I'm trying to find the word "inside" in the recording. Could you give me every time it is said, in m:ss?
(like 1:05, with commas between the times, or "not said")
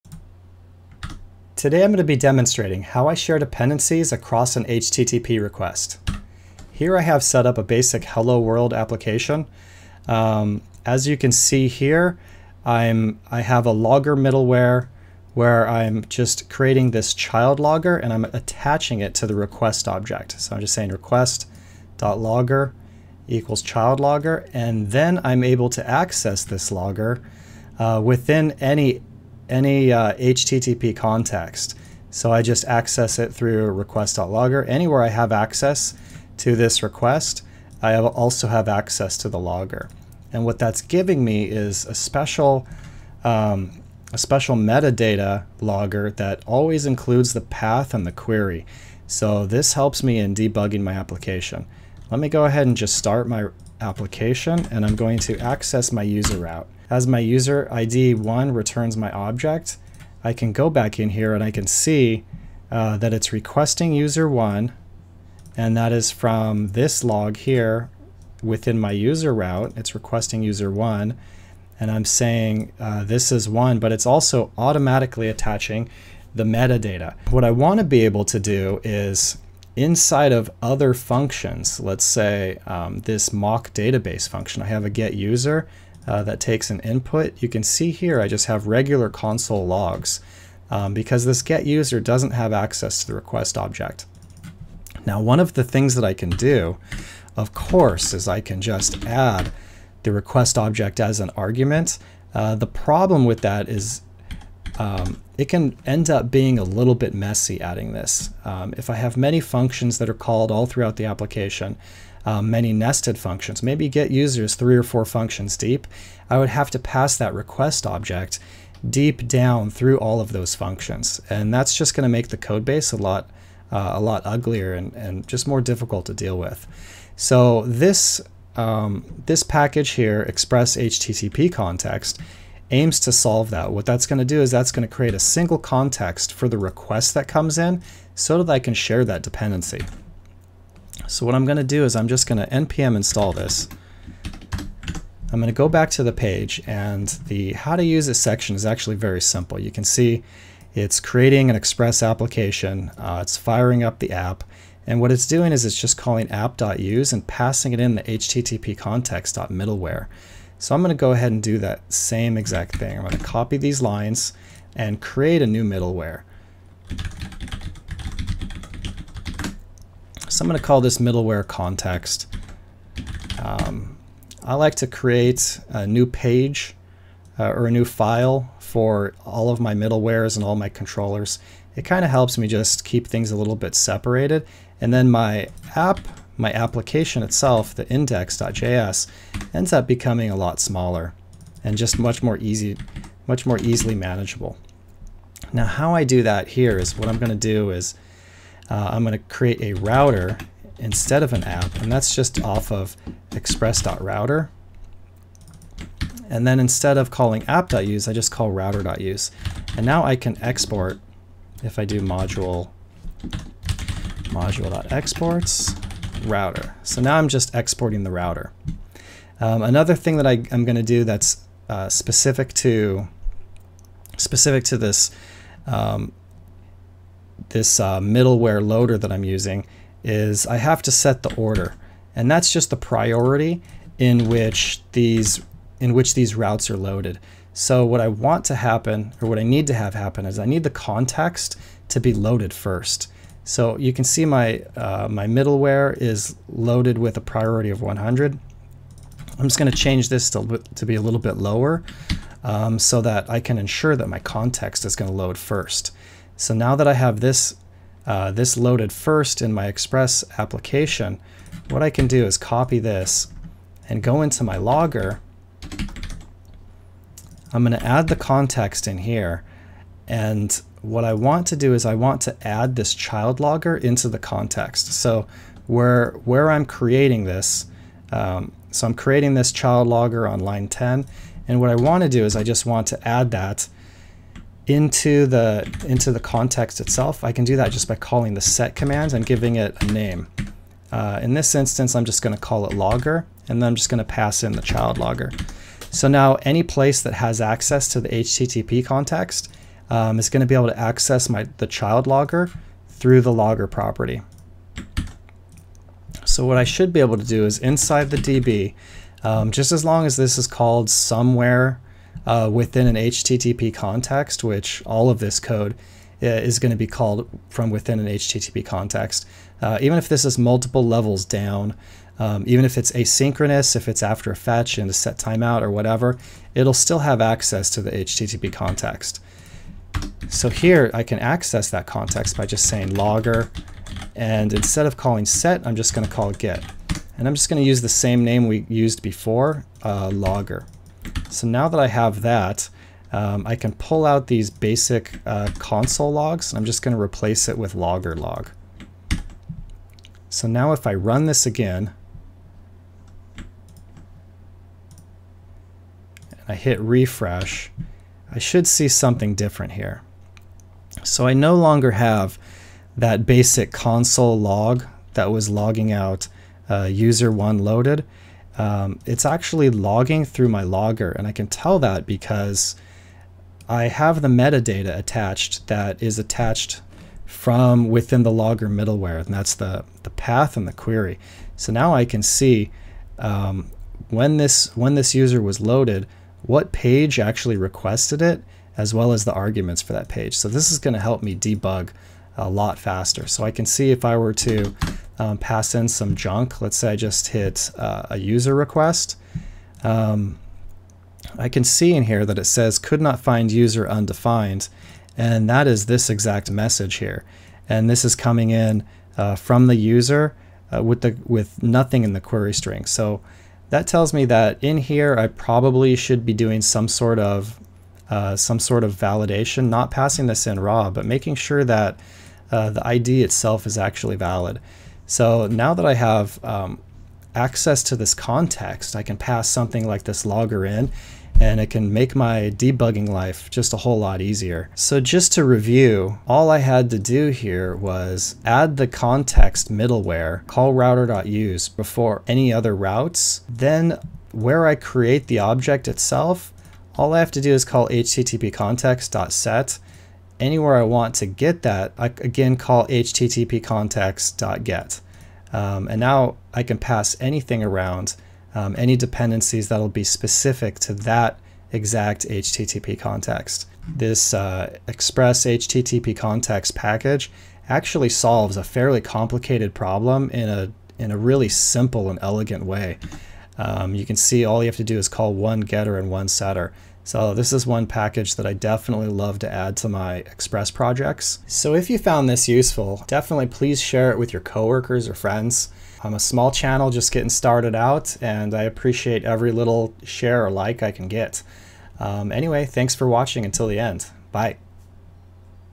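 1:19, 5:07.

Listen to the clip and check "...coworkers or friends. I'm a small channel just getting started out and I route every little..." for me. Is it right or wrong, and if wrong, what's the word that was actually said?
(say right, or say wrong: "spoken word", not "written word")
wrong: "appreciate", not "route".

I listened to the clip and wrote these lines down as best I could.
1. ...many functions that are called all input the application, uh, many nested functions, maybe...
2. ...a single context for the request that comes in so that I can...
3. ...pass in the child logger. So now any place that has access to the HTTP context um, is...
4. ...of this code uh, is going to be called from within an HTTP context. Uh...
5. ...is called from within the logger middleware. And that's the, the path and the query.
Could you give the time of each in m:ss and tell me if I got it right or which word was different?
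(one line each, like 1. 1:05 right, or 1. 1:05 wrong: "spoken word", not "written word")
1. 1:49 wrong: "throughout", not "input"
2. 2:15 right
3. 4:54 right
4. 5:15 right
5. 6:16 wrong: "attached", not "called".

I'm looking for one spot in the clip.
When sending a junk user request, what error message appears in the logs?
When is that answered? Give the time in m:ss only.
6:42.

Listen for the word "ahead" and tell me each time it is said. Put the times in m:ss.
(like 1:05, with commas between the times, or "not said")
0:52, 2:41.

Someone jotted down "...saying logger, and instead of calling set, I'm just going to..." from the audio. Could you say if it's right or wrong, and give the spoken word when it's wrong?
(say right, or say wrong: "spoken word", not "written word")
right.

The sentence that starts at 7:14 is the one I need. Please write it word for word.
So just to review, all I had to do here was add the context middleware, call router.use before any other routes.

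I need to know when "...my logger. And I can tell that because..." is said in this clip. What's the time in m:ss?
6:10.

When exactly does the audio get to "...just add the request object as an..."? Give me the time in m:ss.
1:38.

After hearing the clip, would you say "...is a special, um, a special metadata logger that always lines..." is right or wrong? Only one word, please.
wrong.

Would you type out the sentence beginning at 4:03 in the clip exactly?
So you can see my uh, my middleware is loaded with a priority of 100.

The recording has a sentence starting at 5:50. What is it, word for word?
So now if I run this again, and I hit refresh, I should see something different here.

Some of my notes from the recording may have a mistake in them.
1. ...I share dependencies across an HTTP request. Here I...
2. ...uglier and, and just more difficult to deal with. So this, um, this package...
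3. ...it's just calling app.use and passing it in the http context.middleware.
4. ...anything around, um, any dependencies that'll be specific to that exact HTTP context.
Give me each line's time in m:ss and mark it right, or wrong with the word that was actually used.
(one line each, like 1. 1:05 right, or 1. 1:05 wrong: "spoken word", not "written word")
1. 0:03 right
2. 2:04 right
3. 2:35 right
4. 7:37 right.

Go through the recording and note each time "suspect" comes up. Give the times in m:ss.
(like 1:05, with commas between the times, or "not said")
not said.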